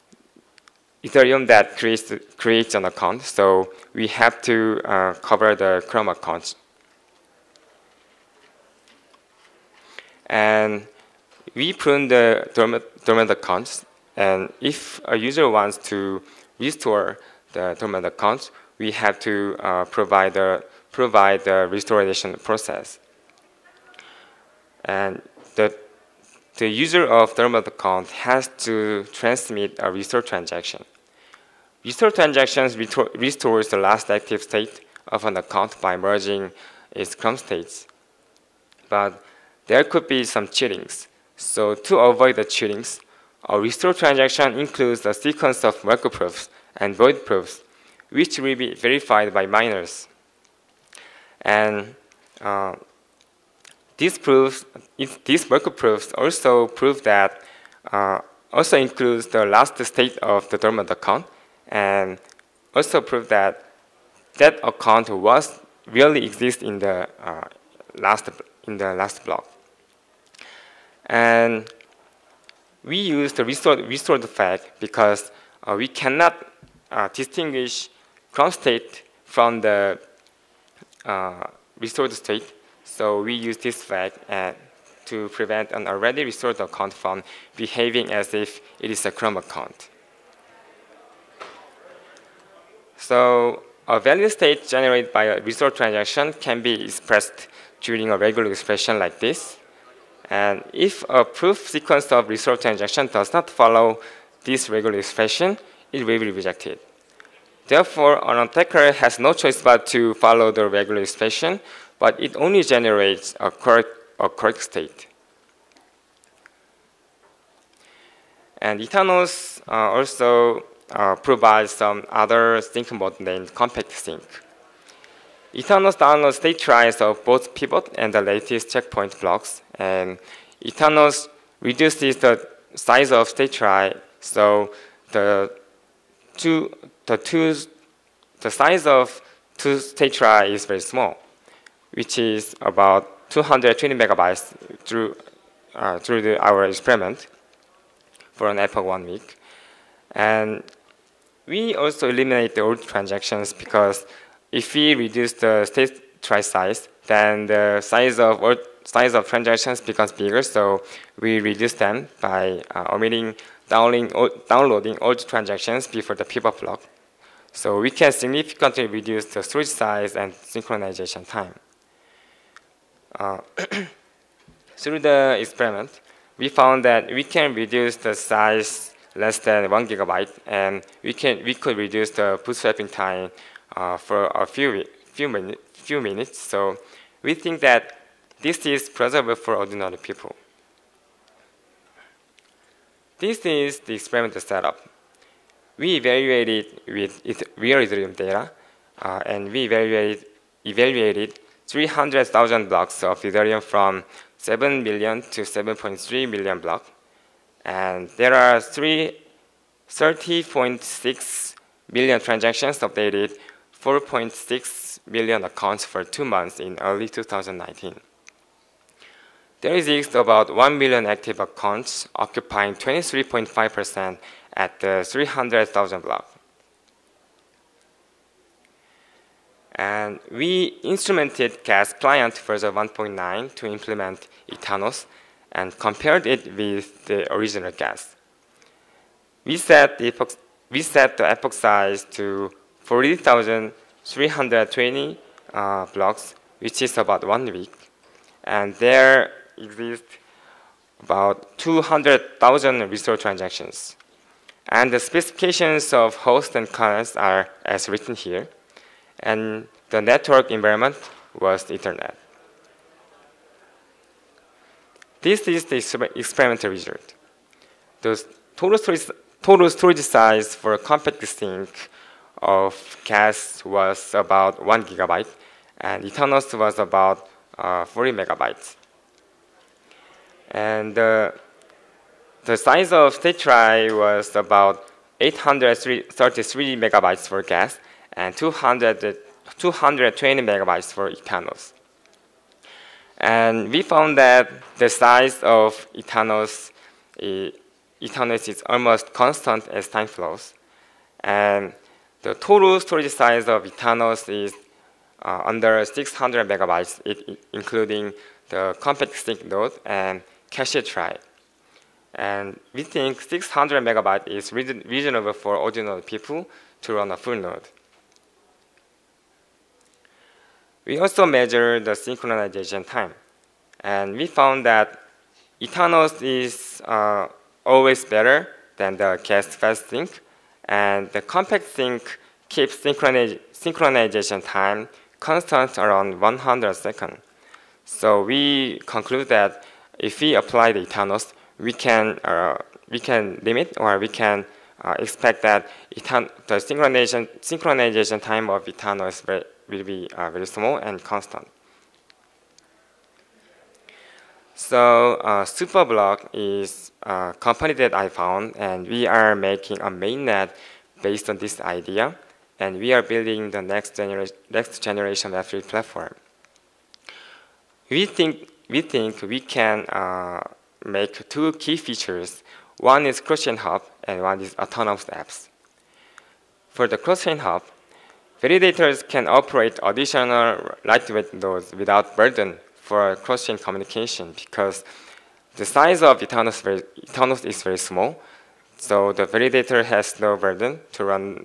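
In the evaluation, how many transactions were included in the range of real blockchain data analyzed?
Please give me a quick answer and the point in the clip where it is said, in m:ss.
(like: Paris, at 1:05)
30.6 million, at 3:28.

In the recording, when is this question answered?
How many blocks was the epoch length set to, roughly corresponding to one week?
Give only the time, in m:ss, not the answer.
4:02.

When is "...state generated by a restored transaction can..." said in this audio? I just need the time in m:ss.
1:34.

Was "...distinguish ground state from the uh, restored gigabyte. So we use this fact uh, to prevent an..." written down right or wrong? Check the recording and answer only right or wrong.
wrong.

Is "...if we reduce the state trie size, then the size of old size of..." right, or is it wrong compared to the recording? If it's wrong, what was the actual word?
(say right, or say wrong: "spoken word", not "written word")
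right.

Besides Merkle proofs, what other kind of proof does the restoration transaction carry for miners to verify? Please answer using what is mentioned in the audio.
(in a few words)
Void proofs.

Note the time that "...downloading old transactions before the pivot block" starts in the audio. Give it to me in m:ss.
2:43.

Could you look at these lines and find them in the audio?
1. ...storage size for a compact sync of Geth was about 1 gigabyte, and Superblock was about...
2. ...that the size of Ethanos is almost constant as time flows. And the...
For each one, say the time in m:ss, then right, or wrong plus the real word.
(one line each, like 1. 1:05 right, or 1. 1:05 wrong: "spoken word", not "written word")
1. 4:29 wrong: "Ethanos", not "Superblock"
2. 4:54 right.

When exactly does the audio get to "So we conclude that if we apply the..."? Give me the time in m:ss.
5:37.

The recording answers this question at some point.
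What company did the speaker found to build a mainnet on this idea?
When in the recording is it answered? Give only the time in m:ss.
5:55.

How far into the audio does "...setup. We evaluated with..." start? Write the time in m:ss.
3:14.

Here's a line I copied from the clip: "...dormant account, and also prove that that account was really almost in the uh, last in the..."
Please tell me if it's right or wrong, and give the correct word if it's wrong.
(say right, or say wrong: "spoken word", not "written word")
wrong: "exist", not "almost".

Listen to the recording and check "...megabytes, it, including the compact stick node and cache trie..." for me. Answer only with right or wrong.
right.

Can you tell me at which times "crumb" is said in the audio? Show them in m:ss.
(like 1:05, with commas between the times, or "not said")
0:05, 1:29.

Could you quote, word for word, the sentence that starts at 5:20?
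We also measured the synchronization time.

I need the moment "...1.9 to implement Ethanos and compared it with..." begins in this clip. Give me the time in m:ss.
3:52.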